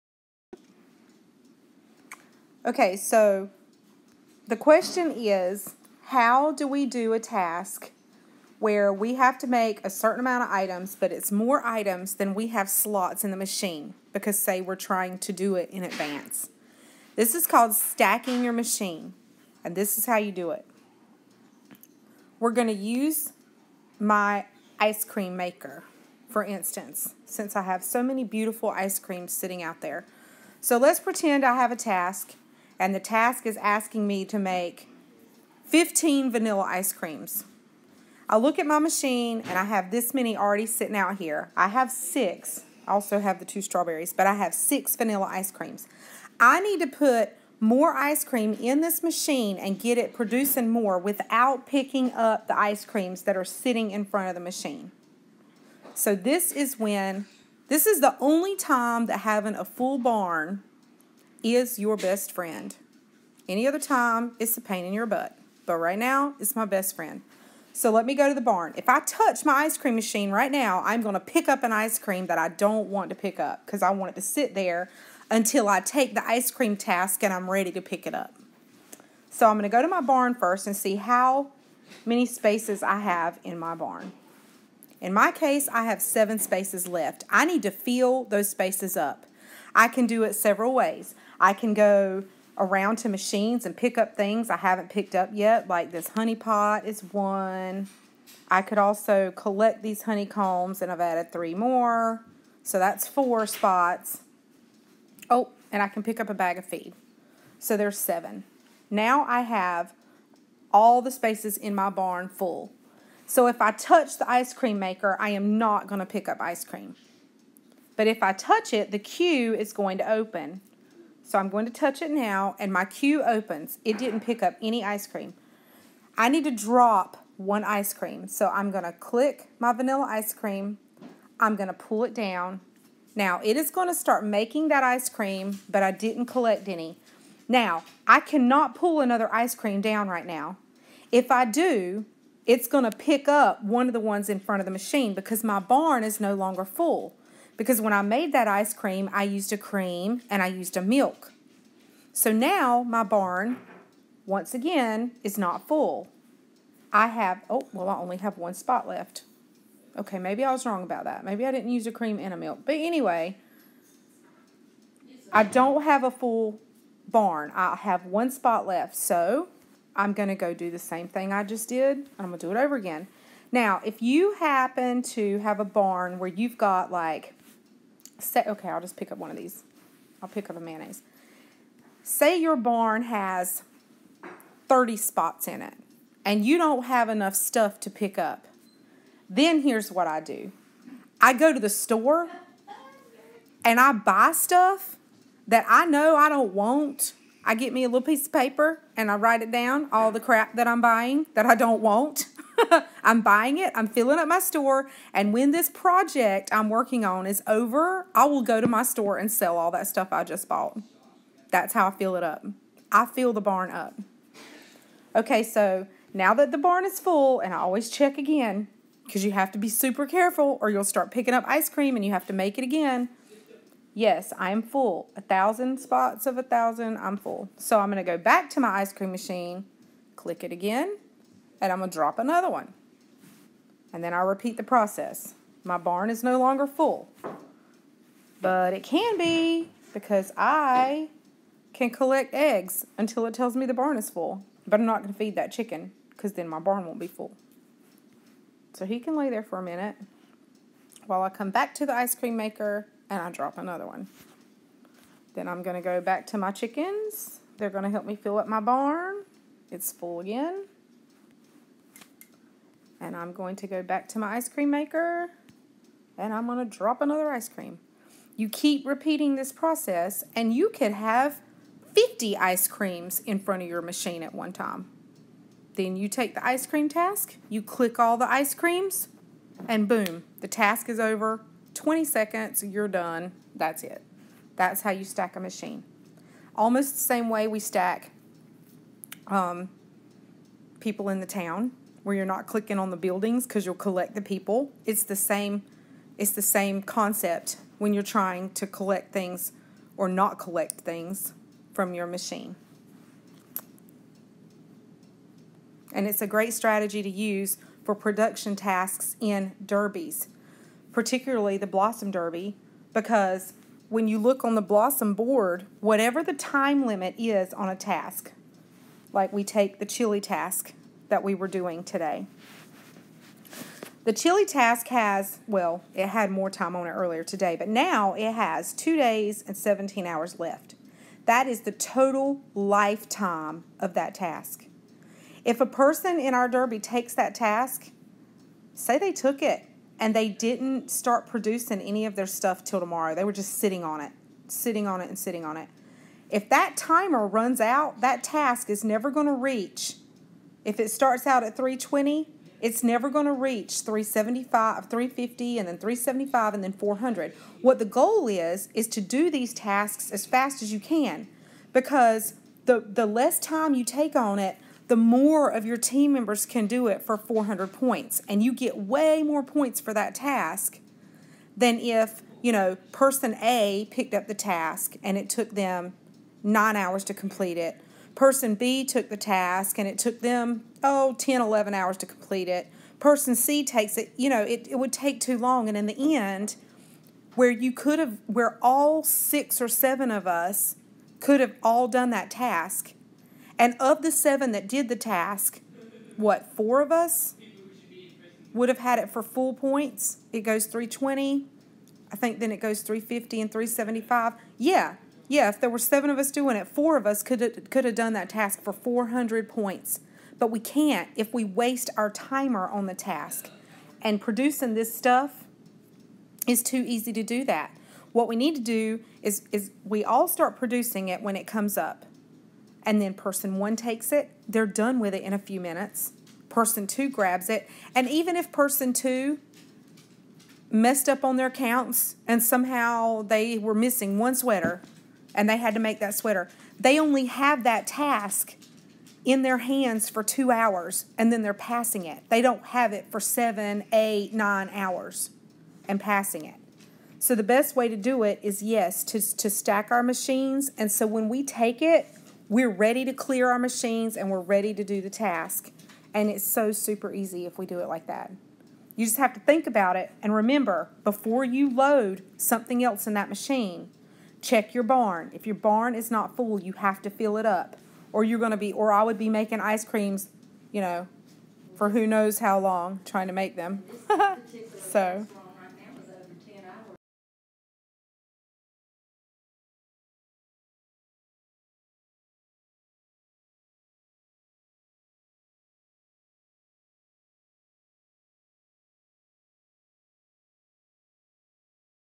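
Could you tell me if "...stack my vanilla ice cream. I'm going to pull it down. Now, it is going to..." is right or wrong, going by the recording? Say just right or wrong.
wrong.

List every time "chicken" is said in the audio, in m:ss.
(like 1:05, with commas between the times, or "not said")
4:05, 4:16.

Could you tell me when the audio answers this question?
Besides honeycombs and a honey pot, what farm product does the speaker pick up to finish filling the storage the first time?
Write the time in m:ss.
1:46.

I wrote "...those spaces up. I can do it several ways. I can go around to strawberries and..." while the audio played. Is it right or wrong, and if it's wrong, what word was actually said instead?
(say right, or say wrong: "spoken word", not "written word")
wrong: "machines", not "strawberries".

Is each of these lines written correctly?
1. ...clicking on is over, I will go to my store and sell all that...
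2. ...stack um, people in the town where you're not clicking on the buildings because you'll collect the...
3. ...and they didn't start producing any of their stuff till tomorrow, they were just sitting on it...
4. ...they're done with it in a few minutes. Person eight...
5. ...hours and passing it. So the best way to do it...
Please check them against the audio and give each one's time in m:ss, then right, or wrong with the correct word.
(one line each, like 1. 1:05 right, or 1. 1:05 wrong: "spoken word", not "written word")
1. 3:26 wrong: "working", not "clicking"
2. 4:47 right
3. 5:39 right
4. 7:04 wrong: "two", not "eight"
5. 7:24 right.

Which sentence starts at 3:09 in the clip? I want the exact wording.
Then here's what I do I go to the store and I buy stuff that I know I don't want.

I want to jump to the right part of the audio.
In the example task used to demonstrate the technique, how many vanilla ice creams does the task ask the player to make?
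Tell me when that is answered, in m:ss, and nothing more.
0:35.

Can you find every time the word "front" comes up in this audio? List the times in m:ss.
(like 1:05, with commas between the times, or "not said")
0:54, 2:24, 4:33.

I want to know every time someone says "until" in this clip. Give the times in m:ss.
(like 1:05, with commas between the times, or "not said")
1:15, 4:02.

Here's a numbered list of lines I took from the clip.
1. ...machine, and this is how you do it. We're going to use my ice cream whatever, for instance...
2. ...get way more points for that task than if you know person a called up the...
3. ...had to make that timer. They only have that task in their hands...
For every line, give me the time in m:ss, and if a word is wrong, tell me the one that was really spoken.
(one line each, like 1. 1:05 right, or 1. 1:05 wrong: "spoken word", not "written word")
1. 0:18 wrong: "maker", not "whatever"
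2. 6:08 wrong: "picked", not "called"
3. 7:15 wrong: "sweater", not "timer".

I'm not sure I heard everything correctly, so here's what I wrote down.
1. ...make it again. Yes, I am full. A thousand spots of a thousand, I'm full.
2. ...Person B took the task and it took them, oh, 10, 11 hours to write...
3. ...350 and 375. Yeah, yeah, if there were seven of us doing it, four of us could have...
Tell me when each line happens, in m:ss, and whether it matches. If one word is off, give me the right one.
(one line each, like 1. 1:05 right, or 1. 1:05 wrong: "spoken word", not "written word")
1. 3:42 right
2. 6:18 wrong: "complete", not "write"
3. 6:42 right.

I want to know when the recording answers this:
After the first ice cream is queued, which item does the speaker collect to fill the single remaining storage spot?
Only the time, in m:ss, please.
3:00.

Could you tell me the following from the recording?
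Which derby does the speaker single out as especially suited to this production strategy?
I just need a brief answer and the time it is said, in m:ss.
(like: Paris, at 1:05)
blossom derby, at 5:11.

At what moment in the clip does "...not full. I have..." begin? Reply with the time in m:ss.
2:35.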